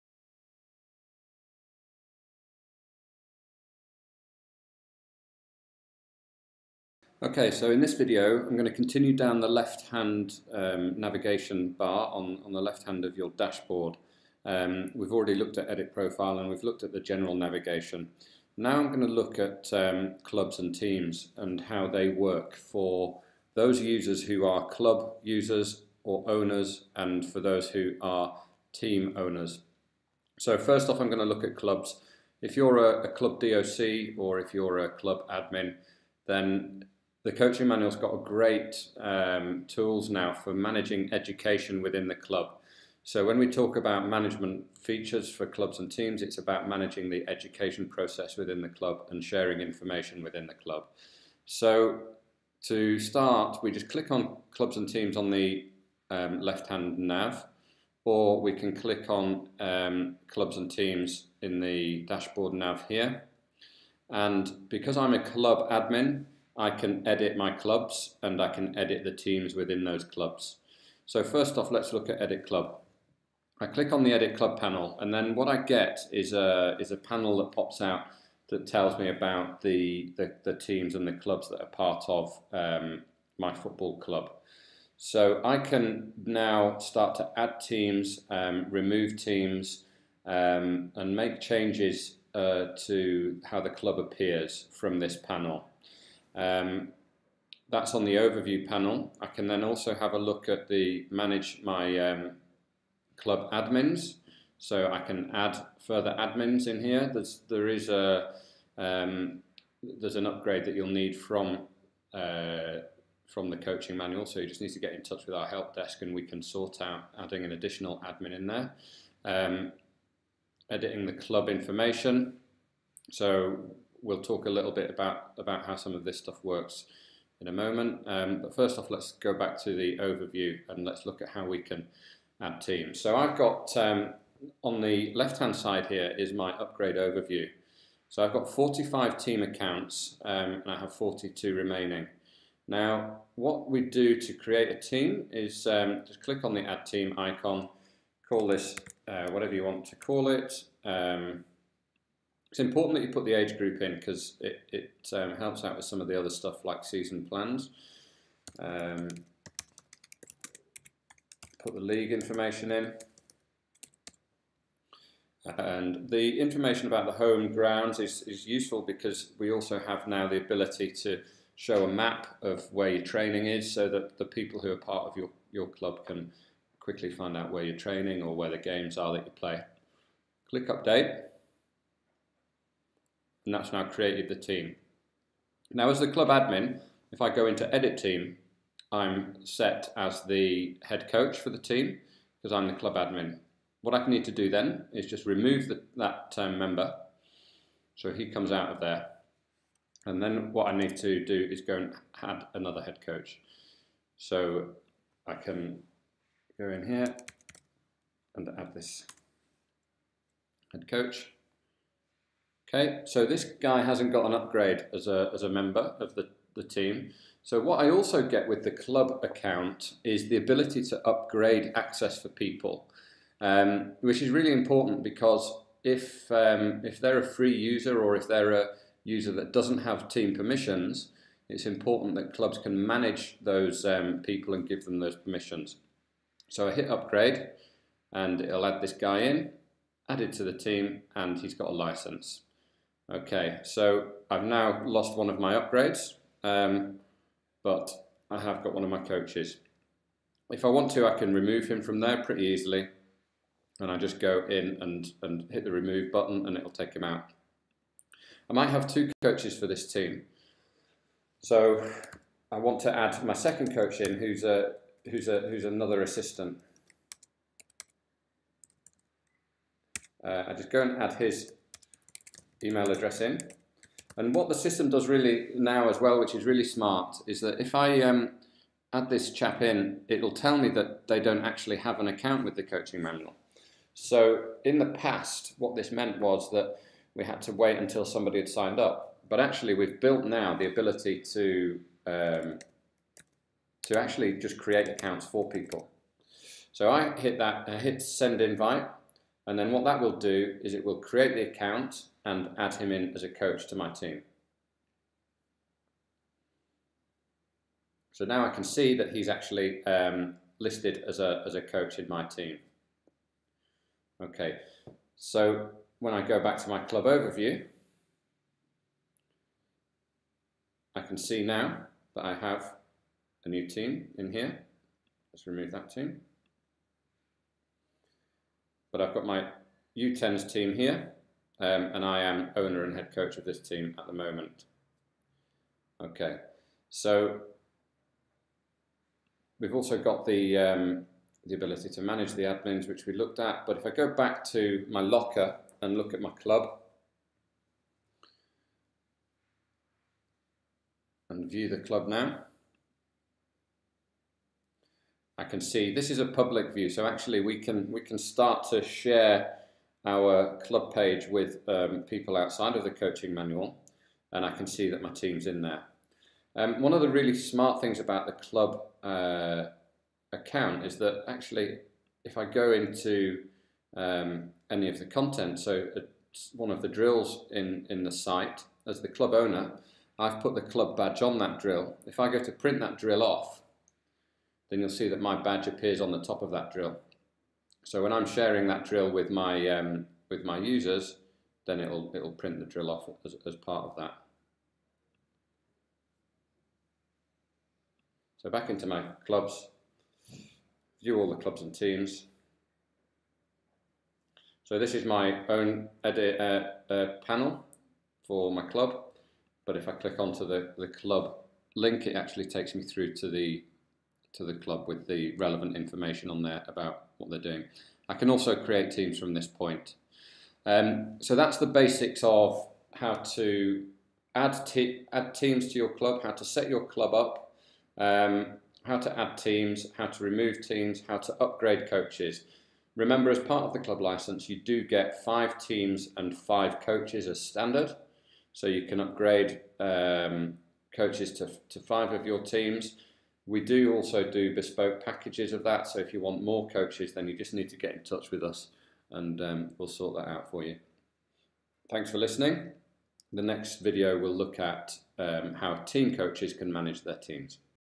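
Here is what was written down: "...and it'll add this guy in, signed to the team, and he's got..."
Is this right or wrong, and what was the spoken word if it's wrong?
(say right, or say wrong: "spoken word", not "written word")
wrong: "added", not "signed".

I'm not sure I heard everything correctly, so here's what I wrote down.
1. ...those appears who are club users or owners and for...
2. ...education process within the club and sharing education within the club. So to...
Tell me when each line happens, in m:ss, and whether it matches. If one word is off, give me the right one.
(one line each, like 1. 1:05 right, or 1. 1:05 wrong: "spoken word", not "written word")
1. 0:23 wrong: "users", not "appears"
2. 0:47 wrong: "information", not "education".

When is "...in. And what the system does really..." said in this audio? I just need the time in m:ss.
4:33.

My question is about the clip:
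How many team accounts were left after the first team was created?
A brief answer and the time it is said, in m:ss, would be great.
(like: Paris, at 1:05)
42, at 2:20.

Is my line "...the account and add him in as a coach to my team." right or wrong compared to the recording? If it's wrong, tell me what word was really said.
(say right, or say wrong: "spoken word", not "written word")
right.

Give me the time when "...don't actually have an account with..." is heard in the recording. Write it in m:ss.
4:41.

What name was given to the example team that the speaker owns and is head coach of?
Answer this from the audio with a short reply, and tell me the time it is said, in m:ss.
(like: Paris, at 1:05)
U10s, at 5:29.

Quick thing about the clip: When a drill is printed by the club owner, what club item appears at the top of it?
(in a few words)
Club badge.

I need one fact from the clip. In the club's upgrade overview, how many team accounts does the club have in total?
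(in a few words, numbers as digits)
45.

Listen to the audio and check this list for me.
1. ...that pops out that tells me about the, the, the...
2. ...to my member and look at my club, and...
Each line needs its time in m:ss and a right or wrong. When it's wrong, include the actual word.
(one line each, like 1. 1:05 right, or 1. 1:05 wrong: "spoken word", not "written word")
1. 1:17 right
2. 5:44 wrong: "locker", not "member".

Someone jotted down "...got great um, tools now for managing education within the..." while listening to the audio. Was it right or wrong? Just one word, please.
right.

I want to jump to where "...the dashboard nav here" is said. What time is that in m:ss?
1:01.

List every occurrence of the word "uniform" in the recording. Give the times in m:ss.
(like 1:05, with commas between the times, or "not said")
not said.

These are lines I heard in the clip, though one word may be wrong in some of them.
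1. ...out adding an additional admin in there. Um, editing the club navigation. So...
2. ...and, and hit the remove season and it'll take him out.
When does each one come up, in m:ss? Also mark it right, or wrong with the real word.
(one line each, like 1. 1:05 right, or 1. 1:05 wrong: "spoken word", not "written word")
1. 1:56 wrong: "information", not "navigation"
2. 4:14 wrong: "button", not "season".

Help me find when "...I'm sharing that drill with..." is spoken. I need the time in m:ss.
6:28.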